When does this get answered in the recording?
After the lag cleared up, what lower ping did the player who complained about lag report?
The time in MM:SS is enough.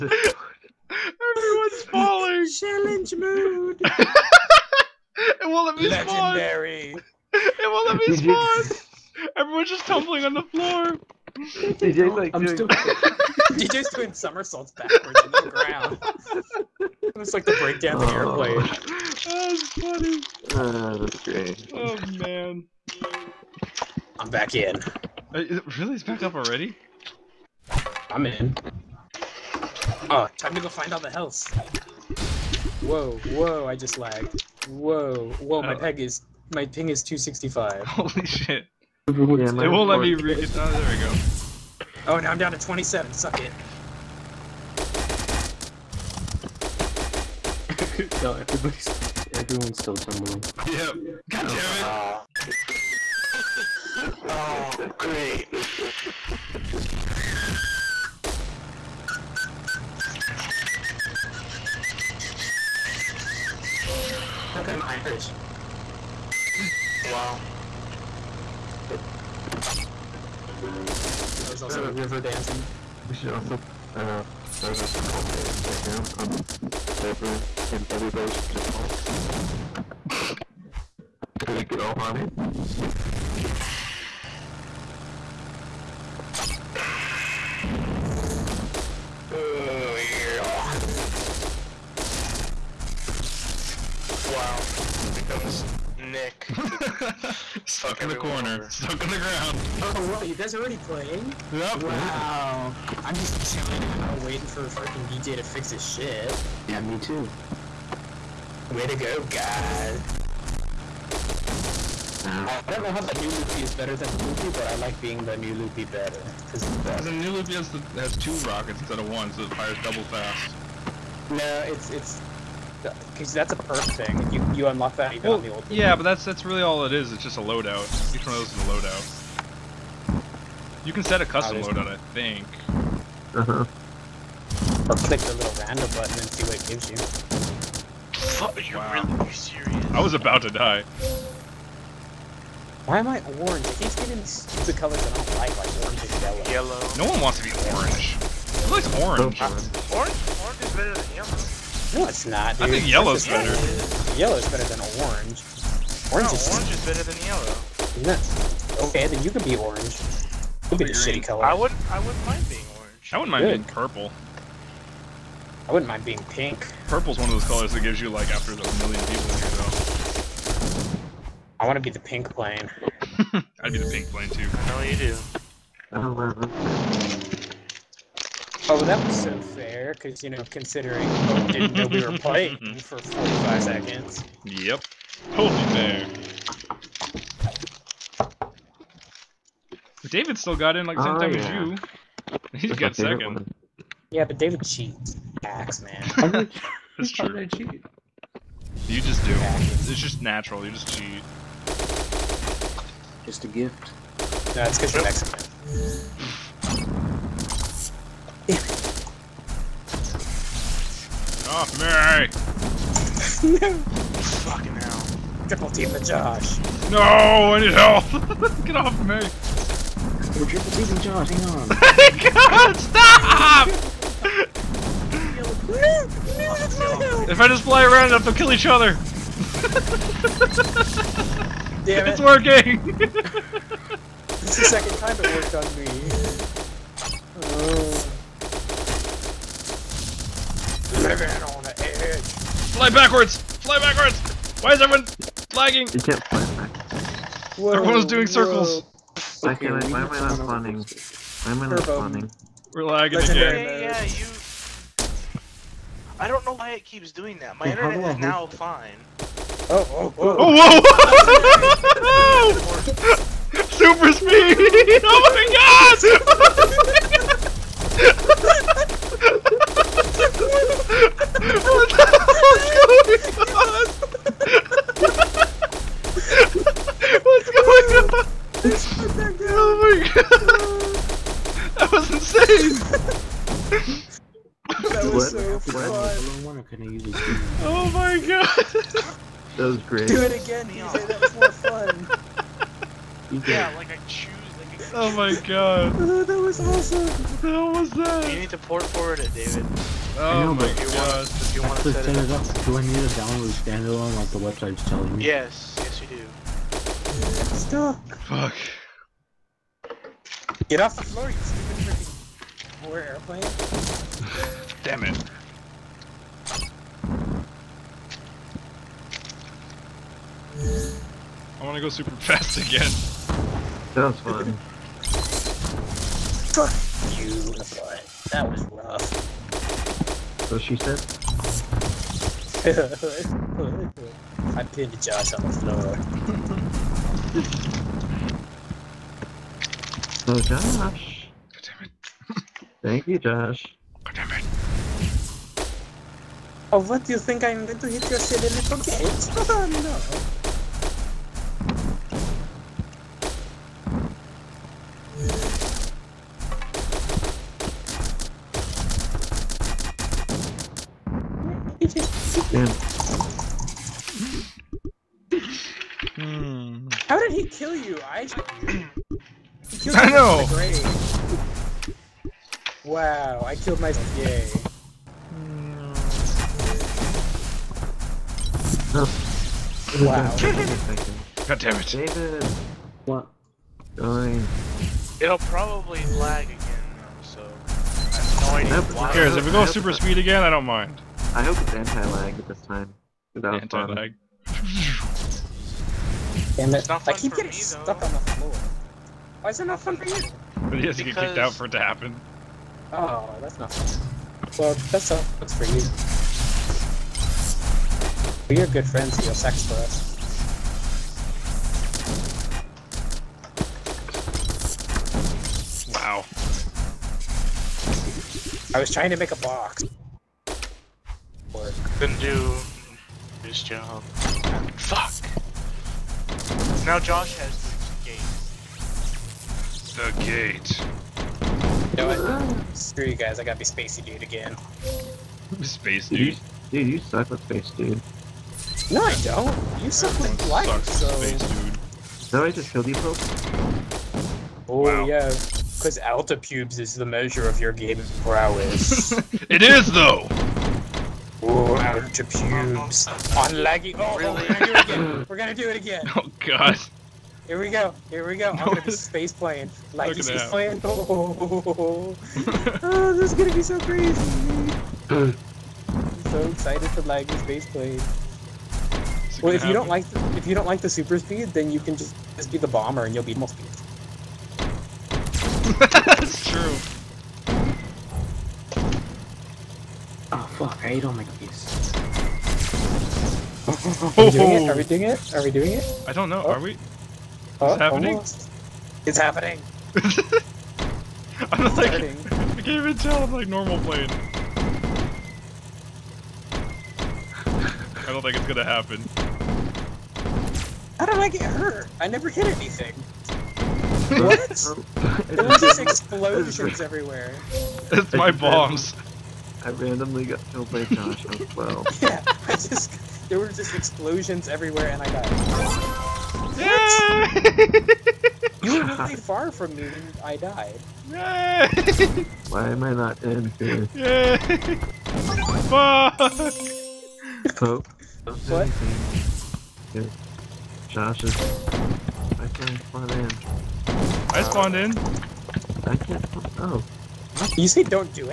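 00:42.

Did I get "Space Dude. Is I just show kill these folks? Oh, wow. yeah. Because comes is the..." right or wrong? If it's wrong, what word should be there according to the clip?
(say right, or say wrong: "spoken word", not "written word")
wrong: "pubes", not "comes".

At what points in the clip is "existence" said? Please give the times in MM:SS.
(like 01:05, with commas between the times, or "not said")
not said.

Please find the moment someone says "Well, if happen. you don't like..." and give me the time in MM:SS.
07:49.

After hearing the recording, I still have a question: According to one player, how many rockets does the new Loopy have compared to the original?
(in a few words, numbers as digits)
2.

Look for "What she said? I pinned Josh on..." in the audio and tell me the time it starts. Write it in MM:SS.
05:30.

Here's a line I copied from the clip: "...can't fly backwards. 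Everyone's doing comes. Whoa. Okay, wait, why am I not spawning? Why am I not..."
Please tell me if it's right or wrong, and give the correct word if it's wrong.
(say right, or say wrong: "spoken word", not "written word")
wrong: "circles", not "comes".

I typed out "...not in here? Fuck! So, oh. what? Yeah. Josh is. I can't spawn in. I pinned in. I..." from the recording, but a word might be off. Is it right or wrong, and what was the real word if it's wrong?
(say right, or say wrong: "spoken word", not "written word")
wrong: "spawned", not "pinned".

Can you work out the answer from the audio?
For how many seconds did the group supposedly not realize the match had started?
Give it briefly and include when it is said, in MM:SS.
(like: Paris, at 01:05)
45, at 03:02.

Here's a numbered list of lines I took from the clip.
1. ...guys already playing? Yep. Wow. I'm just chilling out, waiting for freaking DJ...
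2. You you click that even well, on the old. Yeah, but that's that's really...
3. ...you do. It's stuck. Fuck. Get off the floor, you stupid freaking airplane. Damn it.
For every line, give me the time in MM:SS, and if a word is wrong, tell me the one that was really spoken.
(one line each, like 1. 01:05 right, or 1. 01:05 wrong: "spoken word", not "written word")
1. 01:40 right
2. 02:04 wrong: "unlock", not "click"
3. 05:06 right.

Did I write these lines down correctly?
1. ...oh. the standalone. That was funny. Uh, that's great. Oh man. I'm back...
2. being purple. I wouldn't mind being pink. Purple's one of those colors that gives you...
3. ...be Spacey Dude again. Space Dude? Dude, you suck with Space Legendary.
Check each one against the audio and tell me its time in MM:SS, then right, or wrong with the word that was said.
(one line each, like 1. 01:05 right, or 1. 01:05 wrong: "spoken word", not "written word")
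1. 00:18 wrong: "airplane", not "standalone"
2. 02:43 right
3. 07:13 wrong: "Dude", not "Legendary".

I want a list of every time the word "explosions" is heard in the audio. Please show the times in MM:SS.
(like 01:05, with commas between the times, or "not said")
08:25, 08:33.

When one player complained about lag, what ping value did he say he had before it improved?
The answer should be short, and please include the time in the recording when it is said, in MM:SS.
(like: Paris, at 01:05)
265, at 00:37.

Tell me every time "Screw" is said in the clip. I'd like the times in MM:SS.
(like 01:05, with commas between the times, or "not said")
07:12.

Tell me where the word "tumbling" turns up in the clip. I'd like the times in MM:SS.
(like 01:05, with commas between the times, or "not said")
00:09, 00:49.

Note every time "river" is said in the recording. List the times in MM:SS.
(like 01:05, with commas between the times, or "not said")
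01:11, 01:17.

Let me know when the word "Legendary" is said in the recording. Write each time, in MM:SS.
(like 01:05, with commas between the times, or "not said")
00:05.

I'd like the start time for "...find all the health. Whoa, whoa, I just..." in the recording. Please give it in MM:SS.
00:30.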